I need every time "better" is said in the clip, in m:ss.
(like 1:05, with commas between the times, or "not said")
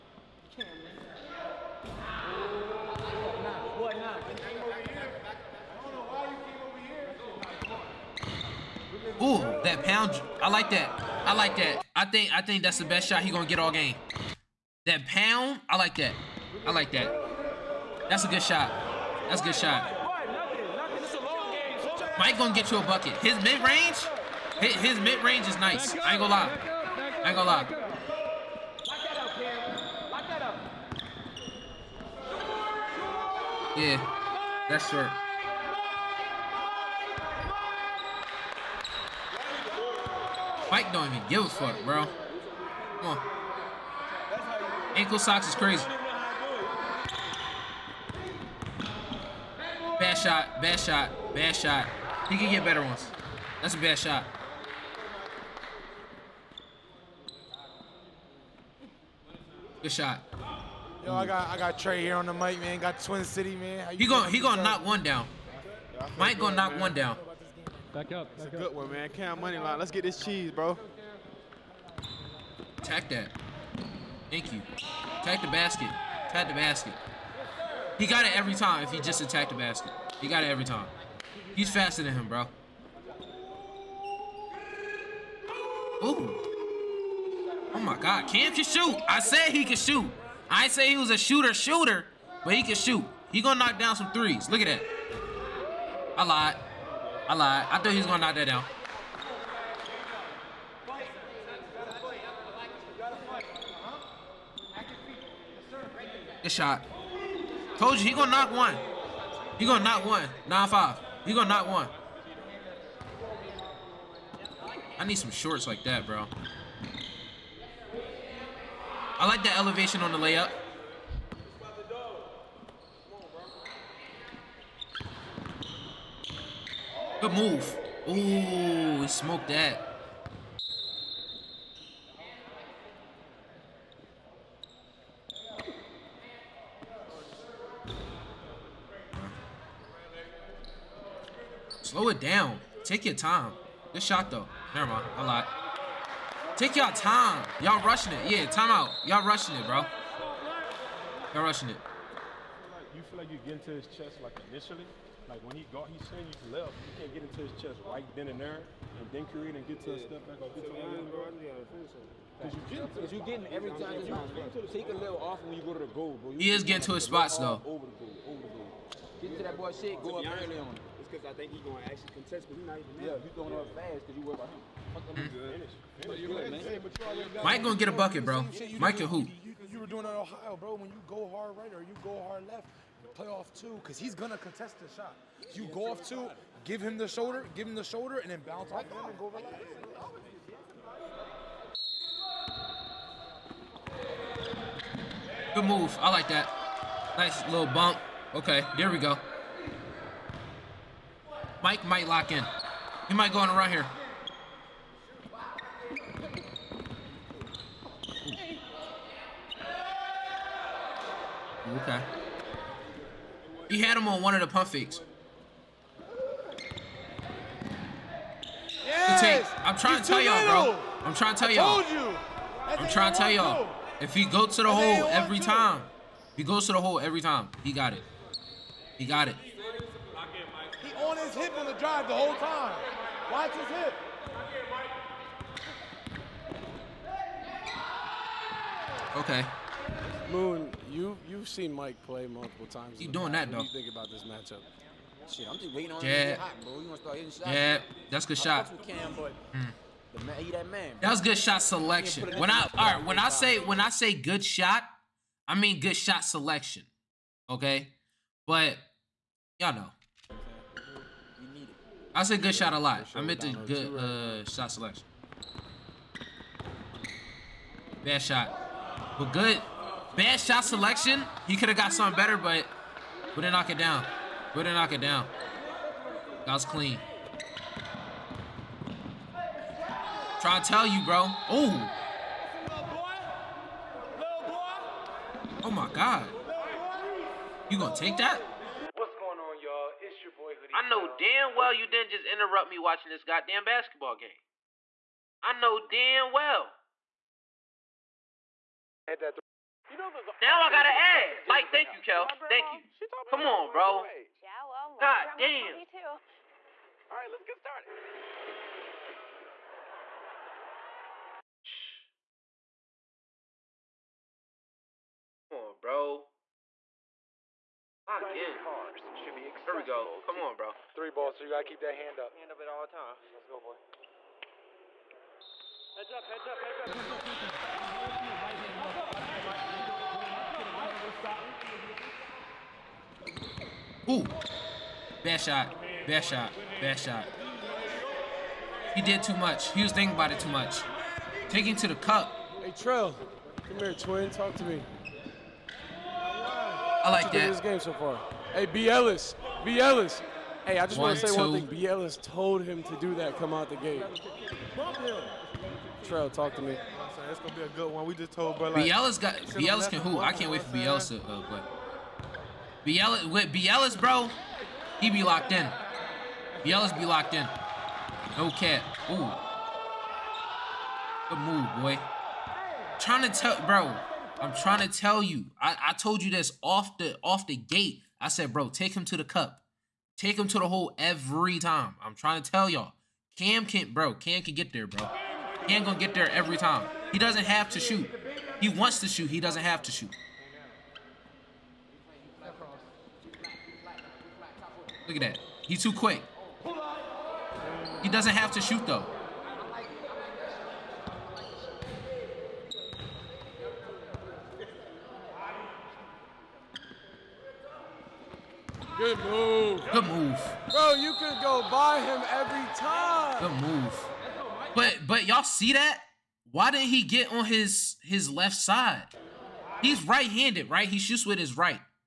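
0:52, 4:32.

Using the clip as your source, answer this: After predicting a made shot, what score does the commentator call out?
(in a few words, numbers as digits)
9-5.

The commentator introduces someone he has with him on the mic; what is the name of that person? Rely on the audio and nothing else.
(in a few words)
Trey.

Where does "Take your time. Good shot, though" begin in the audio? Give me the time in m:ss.
2:22.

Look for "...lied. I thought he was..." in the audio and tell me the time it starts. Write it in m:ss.
1:37.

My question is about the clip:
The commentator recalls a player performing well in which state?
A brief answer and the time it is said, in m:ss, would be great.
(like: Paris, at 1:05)
Ohio, at 3:00.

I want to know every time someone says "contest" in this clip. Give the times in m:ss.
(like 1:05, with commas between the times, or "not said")
2:52, 3:04.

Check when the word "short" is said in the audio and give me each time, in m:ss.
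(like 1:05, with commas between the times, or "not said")
0:34, 1:55.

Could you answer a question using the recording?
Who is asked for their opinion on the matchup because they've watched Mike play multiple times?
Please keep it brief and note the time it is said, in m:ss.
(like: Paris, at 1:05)
Moon, at 4:00.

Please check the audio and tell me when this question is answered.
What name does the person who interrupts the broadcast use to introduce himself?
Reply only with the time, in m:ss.
4:50.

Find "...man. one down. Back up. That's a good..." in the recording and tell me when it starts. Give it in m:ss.
1:06.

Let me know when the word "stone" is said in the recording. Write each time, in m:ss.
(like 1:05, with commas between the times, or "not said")
not said.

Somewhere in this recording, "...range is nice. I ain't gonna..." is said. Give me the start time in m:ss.
0:25.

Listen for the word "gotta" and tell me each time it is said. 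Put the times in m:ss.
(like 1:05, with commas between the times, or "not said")
5:00, 5:21.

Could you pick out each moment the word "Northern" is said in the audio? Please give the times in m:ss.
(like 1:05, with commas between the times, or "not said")
not said.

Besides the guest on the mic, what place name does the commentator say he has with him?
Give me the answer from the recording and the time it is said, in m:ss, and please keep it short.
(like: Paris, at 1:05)
Twin City, at 1:03.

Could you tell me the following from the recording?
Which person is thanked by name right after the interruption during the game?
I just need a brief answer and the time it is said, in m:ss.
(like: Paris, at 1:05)
Kel, at 5:02.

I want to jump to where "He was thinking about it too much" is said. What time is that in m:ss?
5:39.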